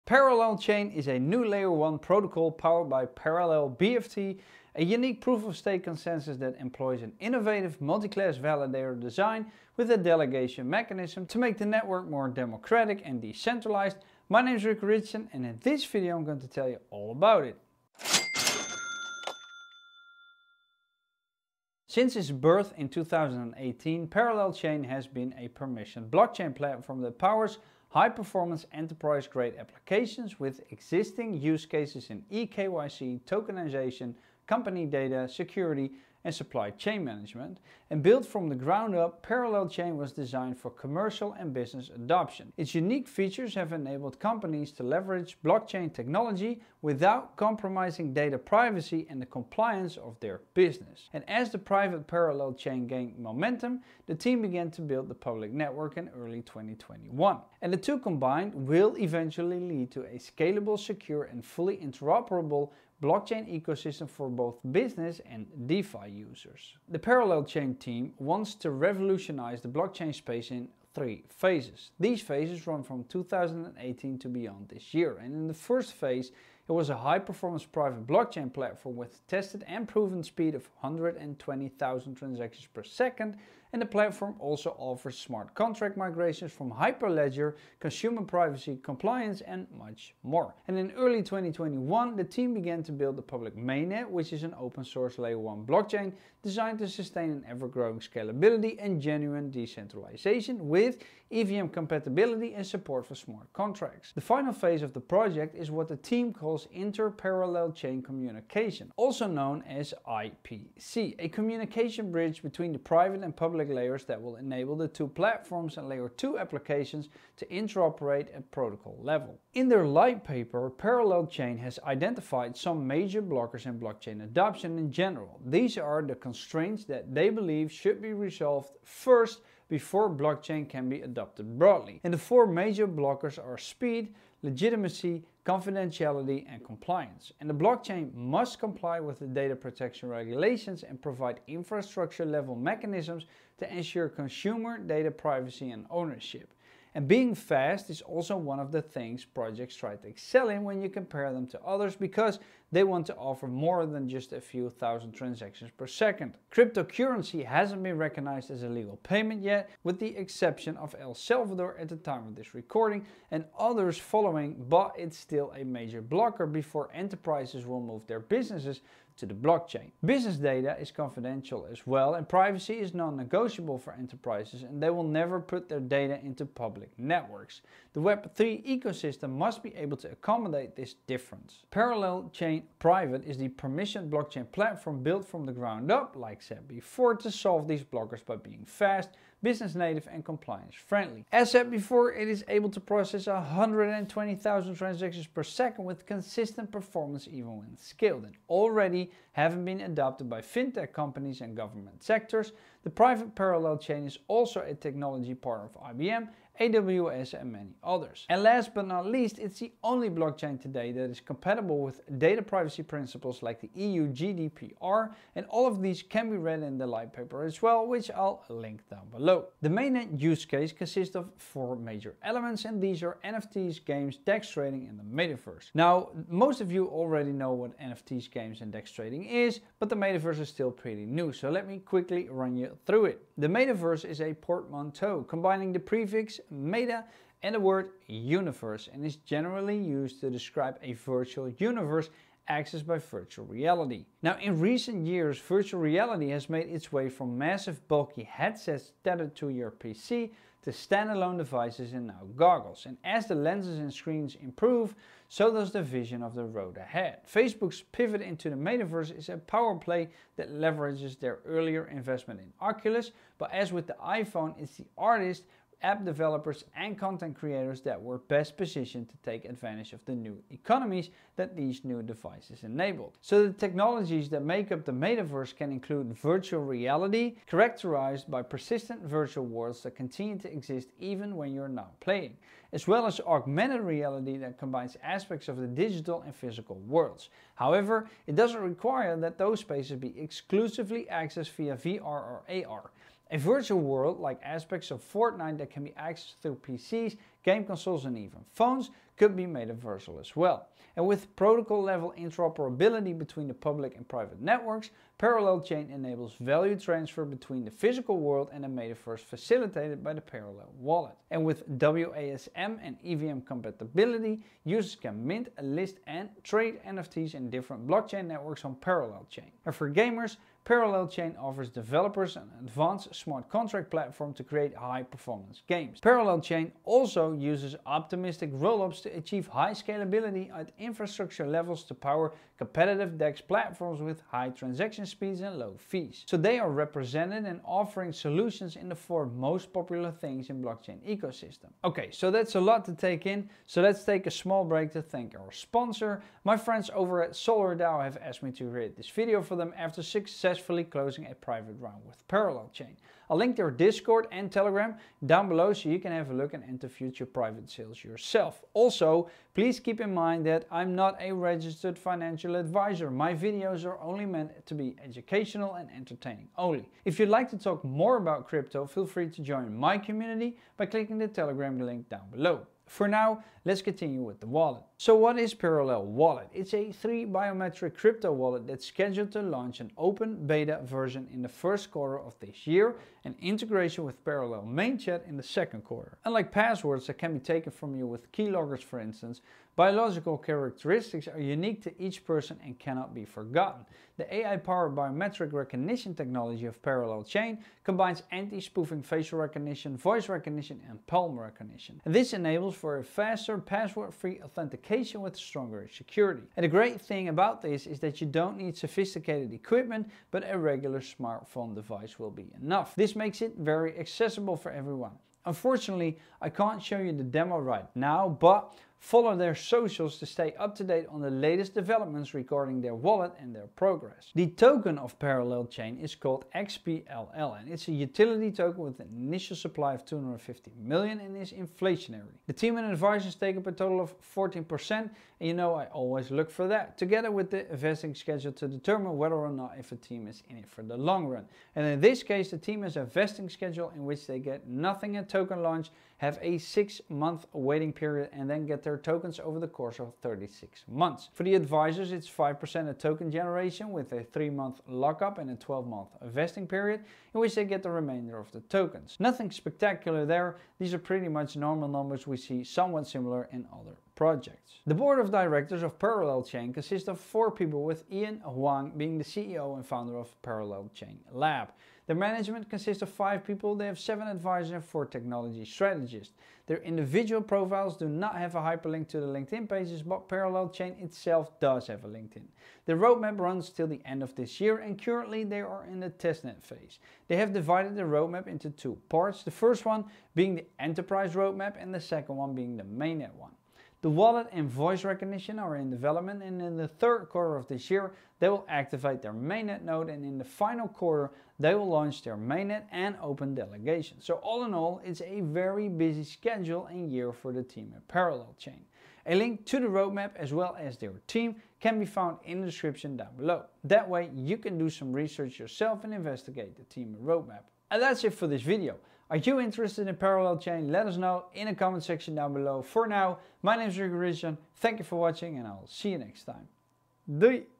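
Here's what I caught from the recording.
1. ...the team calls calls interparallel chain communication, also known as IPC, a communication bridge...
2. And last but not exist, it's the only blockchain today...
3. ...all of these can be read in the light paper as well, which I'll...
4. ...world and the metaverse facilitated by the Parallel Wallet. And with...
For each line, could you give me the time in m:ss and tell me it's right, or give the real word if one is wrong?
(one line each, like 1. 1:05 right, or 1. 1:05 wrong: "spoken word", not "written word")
1. 1:45 right
2. 3:28 wrong: "least", not "exist"
3. 3:35 right
4. 5:08 right.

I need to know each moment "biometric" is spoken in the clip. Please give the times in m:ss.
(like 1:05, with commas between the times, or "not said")
6:17, 6:34.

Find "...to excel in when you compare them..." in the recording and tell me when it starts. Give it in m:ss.
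2:29.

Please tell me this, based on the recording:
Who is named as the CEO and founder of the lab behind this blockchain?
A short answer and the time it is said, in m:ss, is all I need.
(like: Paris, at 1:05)
Ian Huang, at 7:48.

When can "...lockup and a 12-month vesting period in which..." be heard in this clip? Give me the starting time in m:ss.
7:34.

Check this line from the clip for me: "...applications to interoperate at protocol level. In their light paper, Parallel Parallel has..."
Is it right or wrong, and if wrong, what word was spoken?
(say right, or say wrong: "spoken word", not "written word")
wrong: "Chain", not "Parallel".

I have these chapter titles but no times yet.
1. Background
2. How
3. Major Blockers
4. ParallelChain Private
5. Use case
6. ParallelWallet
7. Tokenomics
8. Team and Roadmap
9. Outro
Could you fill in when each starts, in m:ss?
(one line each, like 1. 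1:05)
1. 0:21
2. 1:06
3. 1:59
4. 3:01
5. 3:39
6. 6:14
7. 7:04
8. 7:44
9. 8:37.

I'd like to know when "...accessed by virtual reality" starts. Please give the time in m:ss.
4:02.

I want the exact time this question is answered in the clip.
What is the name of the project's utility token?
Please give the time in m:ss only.
7:06.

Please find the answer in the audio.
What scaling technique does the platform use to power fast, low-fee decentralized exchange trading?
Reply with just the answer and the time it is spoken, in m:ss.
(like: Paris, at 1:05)
Optimistic rollups, at 5:27.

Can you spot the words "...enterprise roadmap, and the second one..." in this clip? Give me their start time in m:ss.
8:10.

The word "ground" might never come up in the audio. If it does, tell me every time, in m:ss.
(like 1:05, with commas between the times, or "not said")
0:38, 3:05.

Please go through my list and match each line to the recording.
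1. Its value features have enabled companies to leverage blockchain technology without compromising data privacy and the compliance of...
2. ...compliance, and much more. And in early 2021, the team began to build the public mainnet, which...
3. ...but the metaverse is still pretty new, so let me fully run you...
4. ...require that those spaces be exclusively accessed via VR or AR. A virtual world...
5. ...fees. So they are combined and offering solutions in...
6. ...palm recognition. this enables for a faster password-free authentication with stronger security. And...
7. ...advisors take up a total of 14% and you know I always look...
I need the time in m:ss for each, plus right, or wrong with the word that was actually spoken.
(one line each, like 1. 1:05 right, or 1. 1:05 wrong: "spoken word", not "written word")
1. 0:42 wrong: "unique", not "value"
2. 1:28 right
3. 3:49 wrong: "quickly", not "fully"
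4. 4:48 right
5. 5:35 wrong: "represented", not "combined"
6. 6:41 right
7. 7:12 right.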